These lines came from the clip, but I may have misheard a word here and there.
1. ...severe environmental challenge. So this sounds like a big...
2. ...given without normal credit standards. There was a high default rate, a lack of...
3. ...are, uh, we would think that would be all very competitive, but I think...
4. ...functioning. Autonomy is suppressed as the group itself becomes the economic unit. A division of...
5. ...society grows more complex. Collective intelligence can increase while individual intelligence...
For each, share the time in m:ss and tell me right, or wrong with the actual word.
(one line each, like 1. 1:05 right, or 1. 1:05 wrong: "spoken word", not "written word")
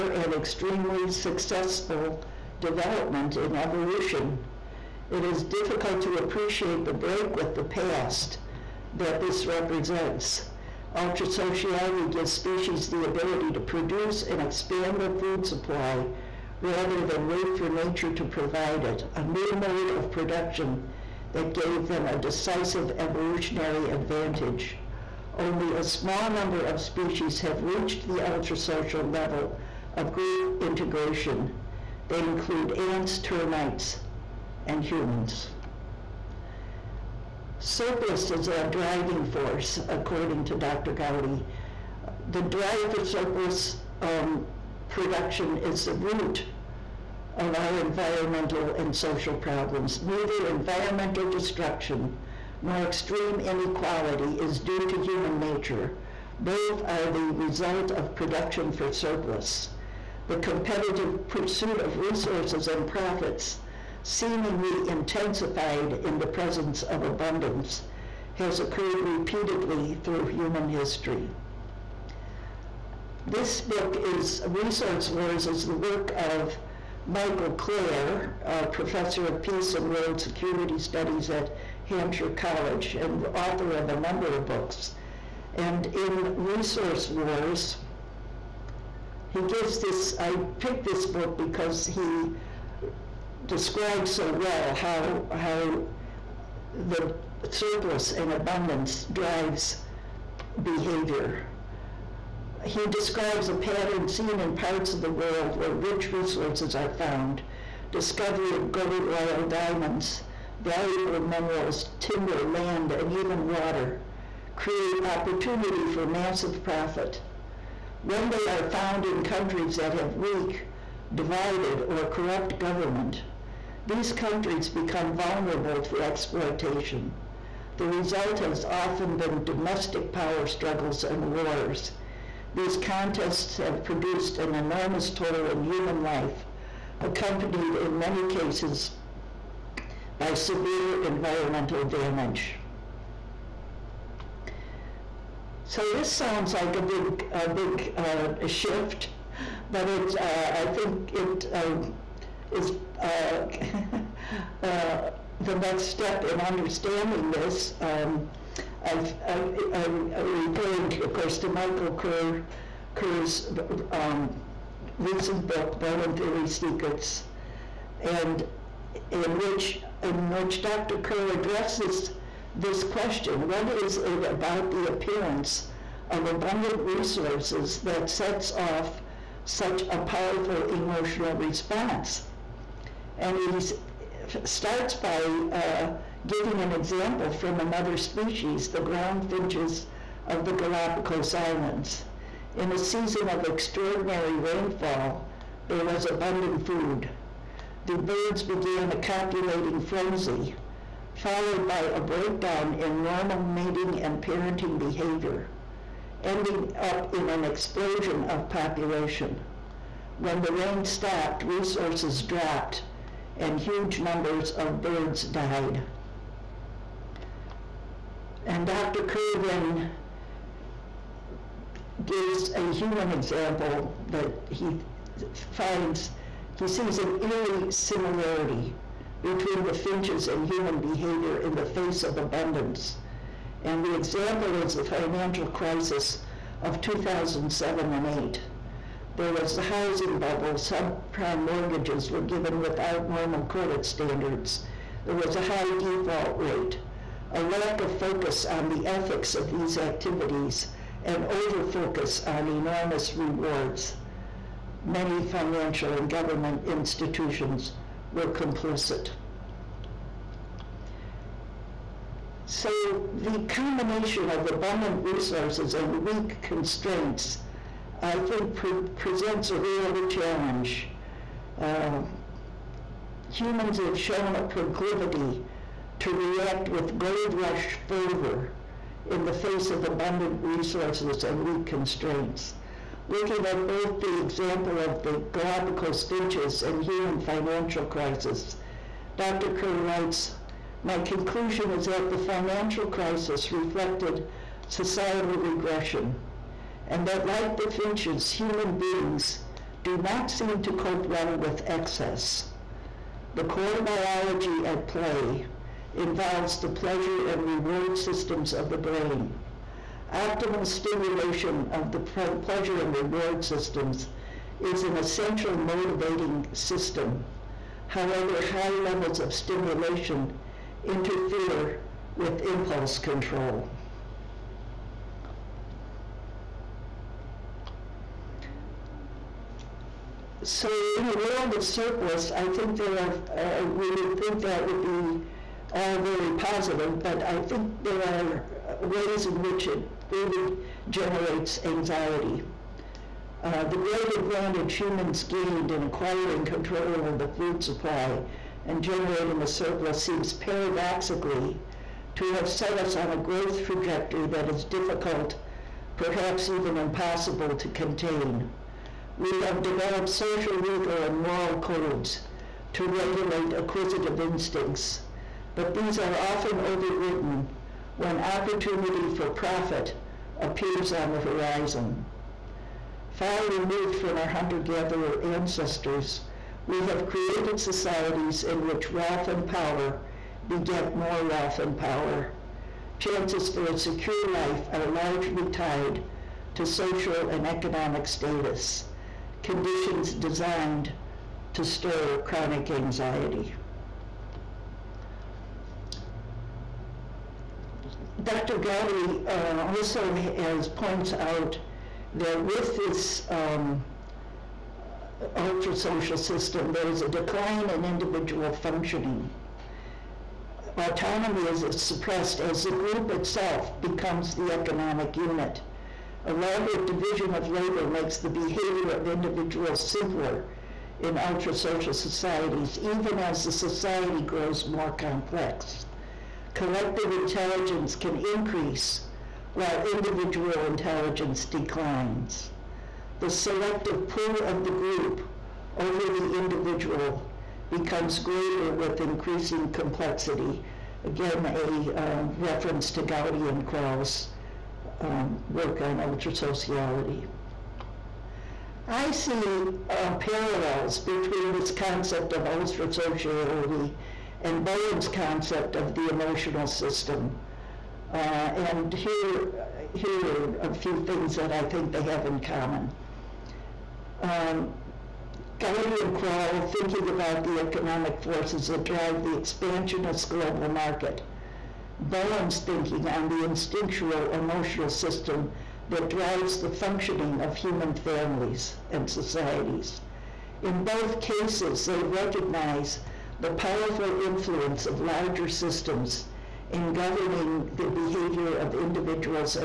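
1. 2:20 wrong: "damage", not "challenge"
2. 4:02 right
3. 5:32 wrong: "positive", not "competitive"
4. 6:48 right
5. 7:03 right.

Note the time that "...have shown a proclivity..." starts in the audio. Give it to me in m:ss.
4:33.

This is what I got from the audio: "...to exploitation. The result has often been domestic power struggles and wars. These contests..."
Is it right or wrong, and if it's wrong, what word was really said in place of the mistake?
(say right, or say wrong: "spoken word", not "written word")
right.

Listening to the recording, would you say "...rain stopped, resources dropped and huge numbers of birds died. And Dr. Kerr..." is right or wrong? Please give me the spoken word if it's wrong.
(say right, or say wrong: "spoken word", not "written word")
right.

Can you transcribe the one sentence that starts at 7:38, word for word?
Uh, and here, here are a few things that I think they have in common.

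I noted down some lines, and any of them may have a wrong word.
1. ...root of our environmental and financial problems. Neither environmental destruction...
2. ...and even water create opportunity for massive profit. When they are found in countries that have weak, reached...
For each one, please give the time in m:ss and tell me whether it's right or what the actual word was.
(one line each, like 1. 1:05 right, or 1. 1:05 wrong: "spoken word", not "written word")
1. 0:45 wrong: "social", not "financial"
2. 1:52 wrong: "divided", not "reached".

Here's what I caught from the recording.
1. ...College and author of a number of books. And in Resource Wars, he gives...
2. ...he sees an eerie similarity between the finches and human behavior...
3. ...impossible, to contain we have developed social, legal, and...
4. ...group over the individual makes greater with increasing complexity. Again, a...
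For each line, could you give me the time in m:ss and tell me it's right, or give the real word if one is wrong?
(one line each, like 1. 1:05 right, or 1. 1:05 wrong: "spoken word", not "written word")
1. 1:22 right
2. 3:46 right
3. 5:56 right
4. 7:14 wrong: "becomes", not "makes".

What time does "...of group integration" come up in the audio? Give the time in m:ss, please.
0:29.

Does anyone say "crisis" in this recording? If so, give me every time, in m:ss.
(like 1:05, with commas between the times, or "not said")
3:55, 4:47, 4:52.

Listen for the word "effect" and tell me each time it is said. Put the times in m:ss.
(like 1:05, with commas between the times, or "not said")
not said.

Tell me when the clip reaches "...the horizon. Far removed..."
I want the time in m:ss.
6:11.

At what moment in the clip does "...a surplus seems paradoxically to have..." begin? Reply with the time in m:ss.
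5:49.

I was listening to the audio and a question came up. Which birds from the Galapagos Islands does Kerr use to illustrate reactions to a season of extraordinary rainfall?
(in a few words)
ground finches.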